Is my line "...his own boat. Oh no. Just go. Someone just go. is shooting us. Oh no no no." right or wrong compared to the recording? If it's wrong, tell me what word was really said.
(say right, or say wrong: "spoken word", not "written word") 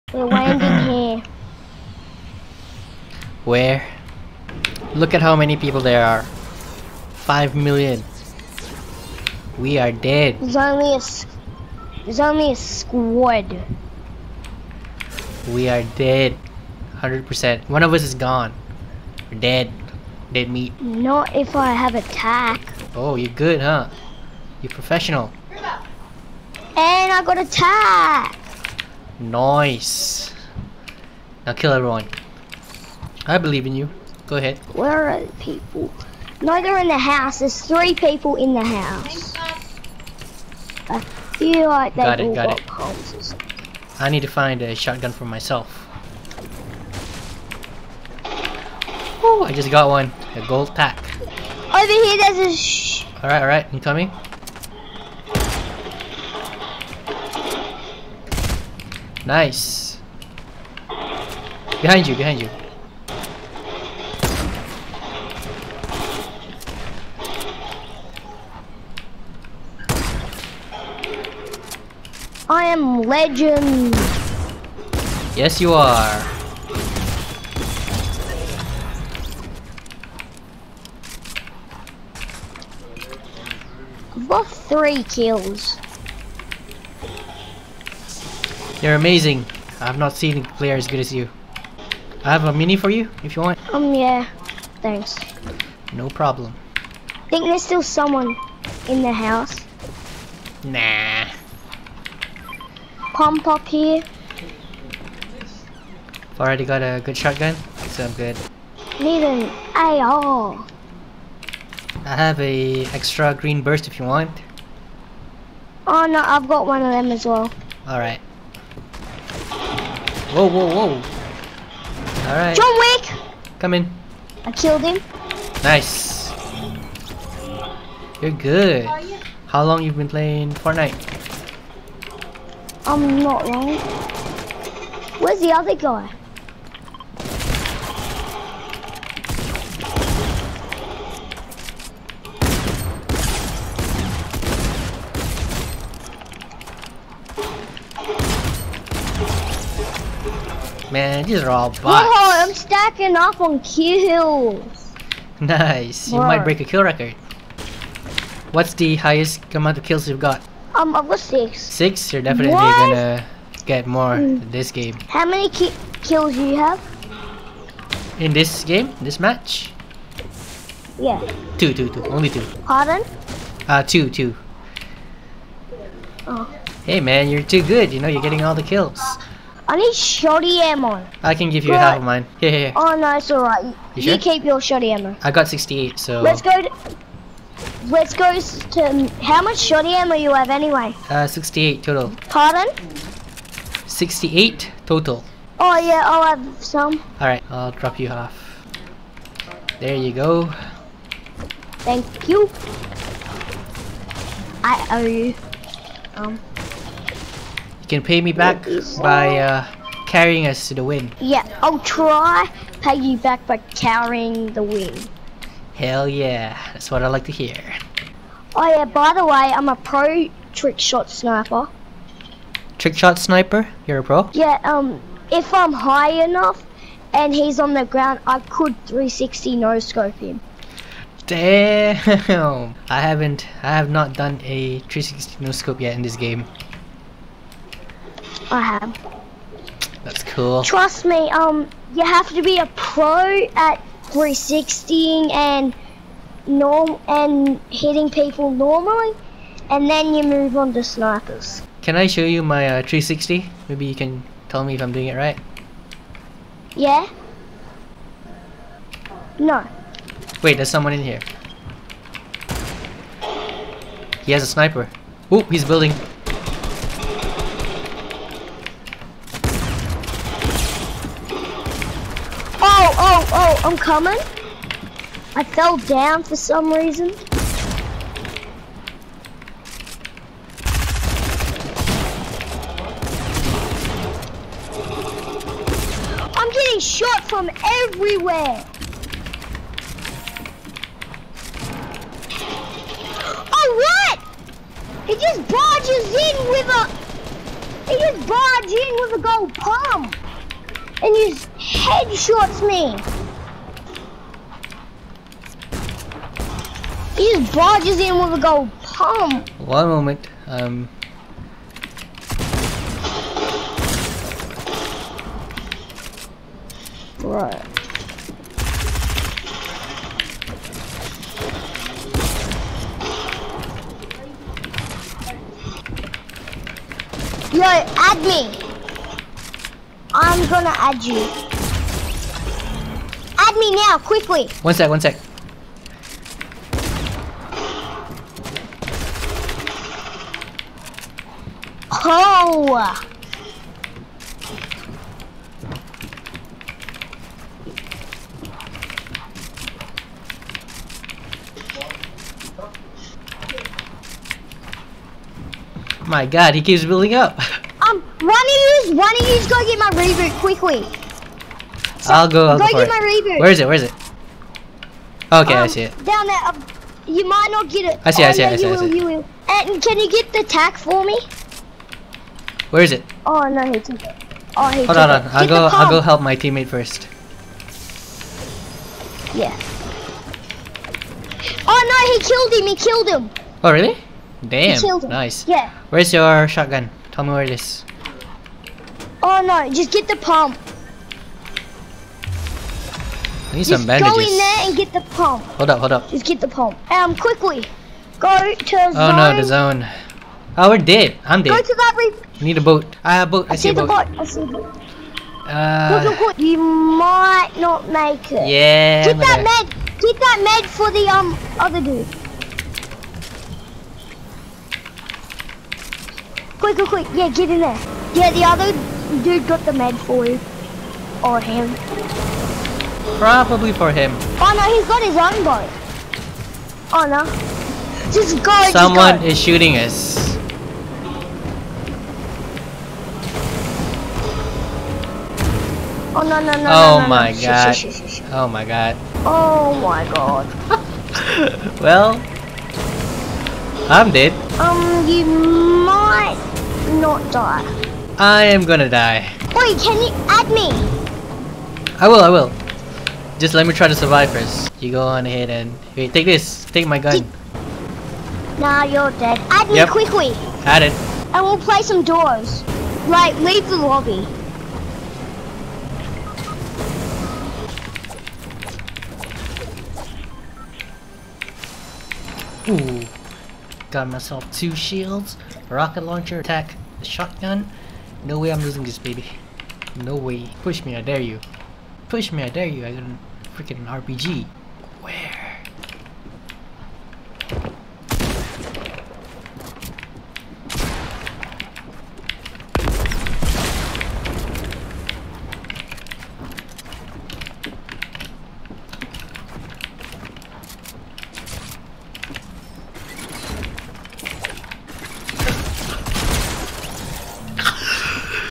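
right.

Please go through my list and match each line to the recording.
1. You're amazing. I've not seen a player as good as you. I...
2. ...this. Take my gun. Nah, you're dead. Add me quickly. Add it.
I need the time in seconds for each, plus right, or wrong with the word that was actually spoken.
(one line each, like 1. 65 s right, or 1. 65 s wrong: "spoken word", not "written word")
1. 88 s right
2. 456 s right.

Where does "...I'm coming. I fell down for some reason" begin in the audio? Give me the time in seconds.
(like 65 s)
273 s.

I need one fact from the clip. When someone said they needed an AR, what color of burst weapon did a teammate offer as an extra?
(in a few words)
Green.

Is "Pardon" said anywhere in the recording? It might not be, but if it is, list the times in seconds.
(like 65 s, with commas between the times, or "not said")
172 s, 192 s.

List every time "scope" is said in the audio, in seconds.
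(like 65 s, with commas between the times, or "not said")
229 s, 235 s.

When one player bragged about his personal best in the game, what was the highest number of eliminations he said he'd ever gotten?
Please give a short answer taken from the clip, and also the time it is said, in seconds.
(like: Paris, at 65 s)
6, at 160 s.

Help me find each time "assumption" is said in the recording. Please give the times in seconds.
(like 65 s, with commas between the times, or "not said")
not said.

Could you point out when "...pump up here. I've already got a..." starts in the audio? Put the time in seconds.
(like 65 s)
103 s.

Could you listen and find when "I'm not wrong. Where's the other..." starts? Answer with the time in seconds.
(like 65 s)
132 s.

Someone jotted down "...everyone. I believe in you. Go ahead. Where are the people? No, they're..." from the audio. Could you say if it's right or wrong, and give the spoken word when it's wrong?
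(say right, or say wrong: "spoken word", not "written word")
right.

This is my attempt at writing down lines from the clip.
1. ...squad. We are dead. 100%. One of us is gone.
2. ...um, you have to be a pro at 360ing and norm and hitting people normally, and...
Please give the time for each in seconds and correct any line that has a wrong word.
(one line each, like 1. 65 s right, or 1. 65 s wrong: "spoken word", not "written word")
1. 12 s right
2. 241 s right.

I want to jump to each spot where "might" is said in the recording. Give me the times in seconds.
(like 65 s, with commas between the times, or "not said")
156 s, 367 s, 406 s, 445 s.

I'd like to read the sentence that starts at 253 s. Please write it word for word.
Maybe you can tell me if I'm doing it right.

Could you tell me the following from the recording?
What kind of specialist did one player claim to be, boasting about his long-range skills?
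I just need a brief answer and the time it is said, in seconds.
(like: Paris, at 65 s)
Pro trick shot sniper, at 219 s.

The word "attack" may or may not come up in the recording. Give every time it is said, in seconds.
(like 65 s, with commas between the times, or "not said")
21 s, 27 s, 476 s.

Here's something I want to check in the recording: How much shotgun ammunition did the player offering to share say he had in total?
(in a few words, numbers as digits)
68.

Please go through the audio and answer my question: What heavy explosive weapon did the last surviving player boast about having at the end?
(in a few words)
RPG.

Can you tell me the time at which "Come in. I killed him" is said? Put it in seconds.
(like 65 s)
123 s.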